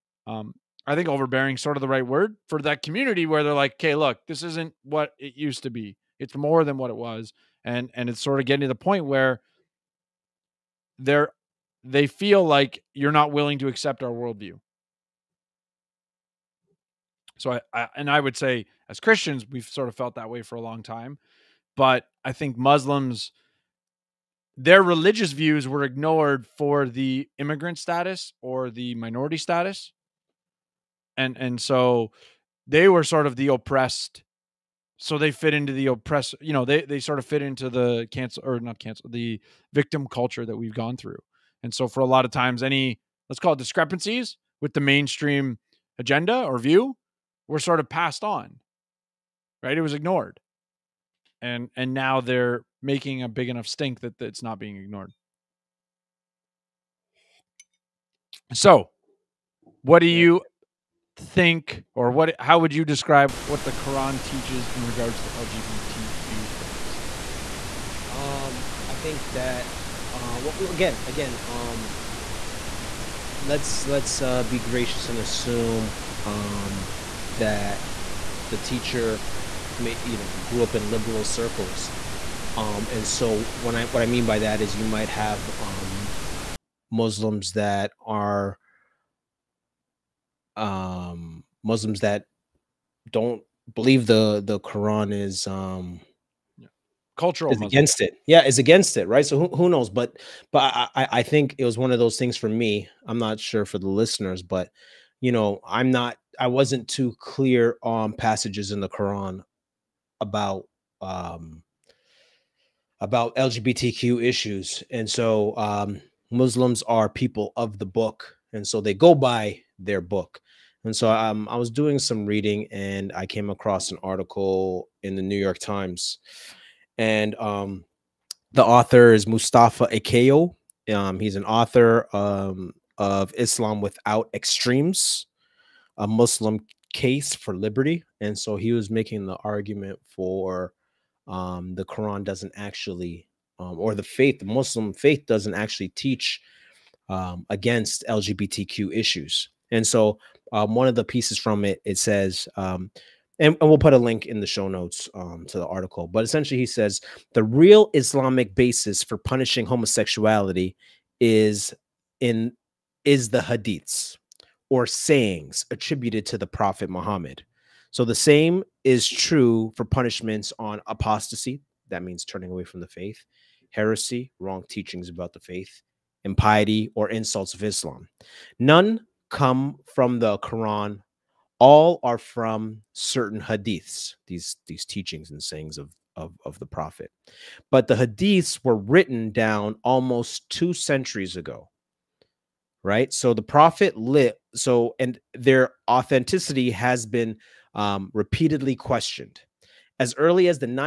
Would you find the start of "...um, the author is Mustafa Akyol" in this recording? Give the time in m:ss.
2:07.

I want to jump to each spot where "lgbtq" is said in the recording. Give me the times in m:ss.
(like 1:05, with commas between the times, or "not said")
1:05, 1:53, 2:28.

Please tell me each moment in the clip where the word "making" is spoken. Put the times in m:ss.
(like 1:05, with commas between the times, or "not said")
0:52, 2:18.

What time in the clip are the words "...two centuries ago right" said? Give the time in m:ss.
3:10.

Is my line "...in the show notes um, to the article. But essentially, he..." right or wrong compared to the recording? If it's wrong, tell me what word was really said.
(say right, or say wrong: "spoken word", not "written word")
right.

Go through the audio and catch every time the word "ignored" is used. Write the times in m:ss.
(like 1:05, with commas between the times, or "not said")
0:25, 0:49, 0:54.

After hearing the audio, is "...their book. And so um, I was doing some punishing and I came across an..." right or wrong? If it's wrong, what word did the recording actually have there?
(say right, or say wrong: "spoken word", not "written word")
wrong: "reading", not "punishing".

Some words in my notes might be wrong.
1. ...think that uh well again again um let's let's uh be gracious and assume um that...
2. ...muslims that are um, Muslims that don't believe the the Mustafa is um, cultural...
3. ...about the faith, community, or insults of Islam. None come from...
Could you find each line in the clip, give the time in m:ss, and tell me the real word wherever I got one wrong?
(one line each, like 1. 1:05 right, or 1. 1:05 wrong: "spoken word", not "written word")
1. 1:08 right
2. 1:26 wrong: "Quran", not "Mustafa"
3. 2:55 wrong: "impiety", not "community".